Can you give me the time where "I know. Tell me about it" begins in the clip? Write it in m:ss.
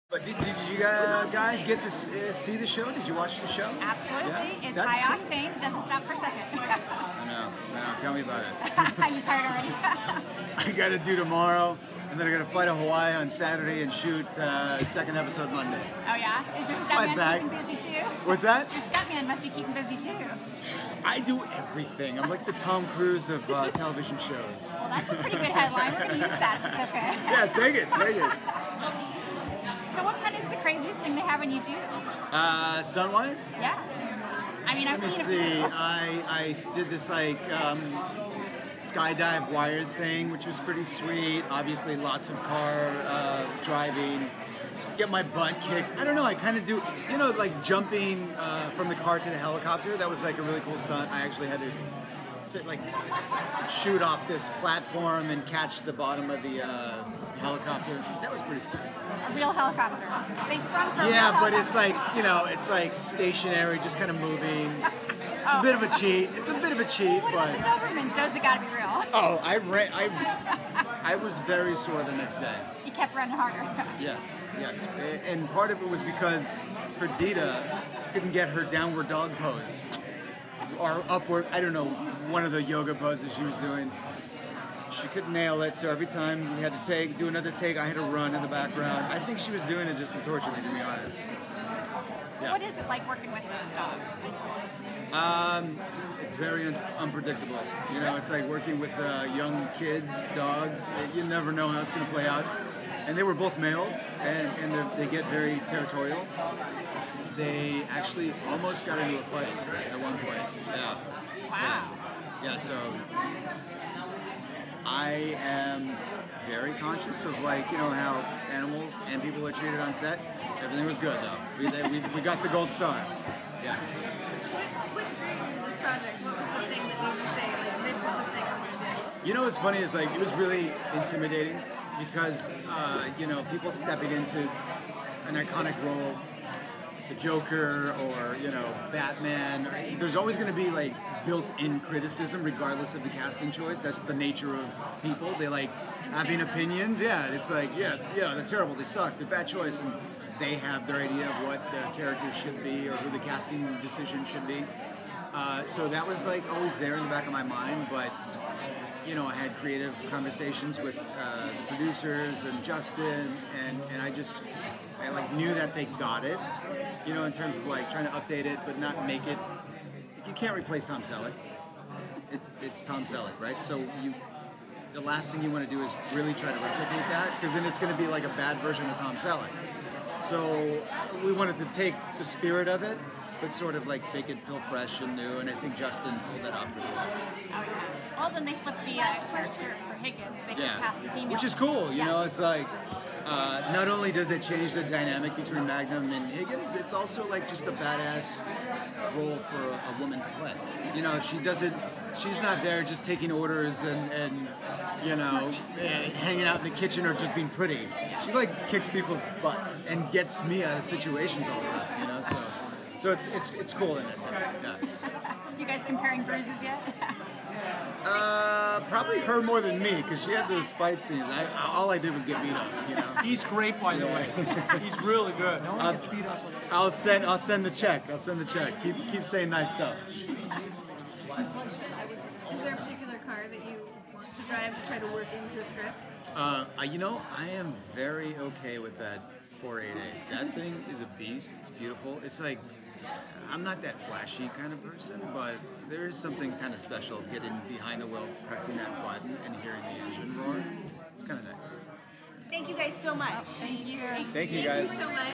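0:07.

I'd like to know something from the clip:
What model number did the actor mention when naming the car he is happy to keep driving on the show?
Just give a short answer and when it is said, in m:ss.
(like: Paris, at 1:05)
488, at 3:59.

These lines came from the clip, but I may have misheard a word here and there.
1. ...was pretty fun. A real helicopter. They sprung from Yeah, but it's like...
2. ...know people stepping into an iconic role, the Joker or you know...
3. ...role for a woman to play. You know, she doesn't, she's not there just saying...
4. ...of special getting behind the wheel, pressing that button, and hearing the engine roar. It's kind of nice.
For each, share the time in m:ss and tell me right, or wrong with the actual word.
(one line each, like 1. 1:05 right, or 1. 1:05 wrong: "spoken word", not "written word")
1. 0:58 right
2. 2:13 right
3. 3:19 wrong: "taking", not "saying"
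4. 4:06 right.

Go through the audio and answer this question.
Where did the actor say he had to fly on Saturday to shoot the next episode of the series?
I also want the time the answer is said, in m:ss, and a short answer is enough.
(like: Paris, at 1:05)
Hawaii, at 0:12.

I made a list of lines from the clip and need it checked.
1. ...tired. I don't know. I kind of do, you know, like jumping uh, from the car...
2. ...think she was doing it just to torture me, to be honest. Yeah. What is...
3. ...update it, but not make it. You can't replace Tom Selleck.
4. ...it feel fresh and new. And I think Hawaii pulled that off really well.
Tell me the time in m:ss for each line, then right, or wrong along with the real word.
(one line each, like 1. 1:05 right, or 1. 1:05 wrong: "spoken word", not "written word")
1. 0:45 wrong: "kicked", not "tired"
2. 1:29 right
3. 2:48 right
4. 3:04 wrong: "Justin", not "Hawaii".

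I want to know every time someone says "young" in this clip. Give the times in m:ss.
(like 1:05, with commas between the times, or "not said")
1:39.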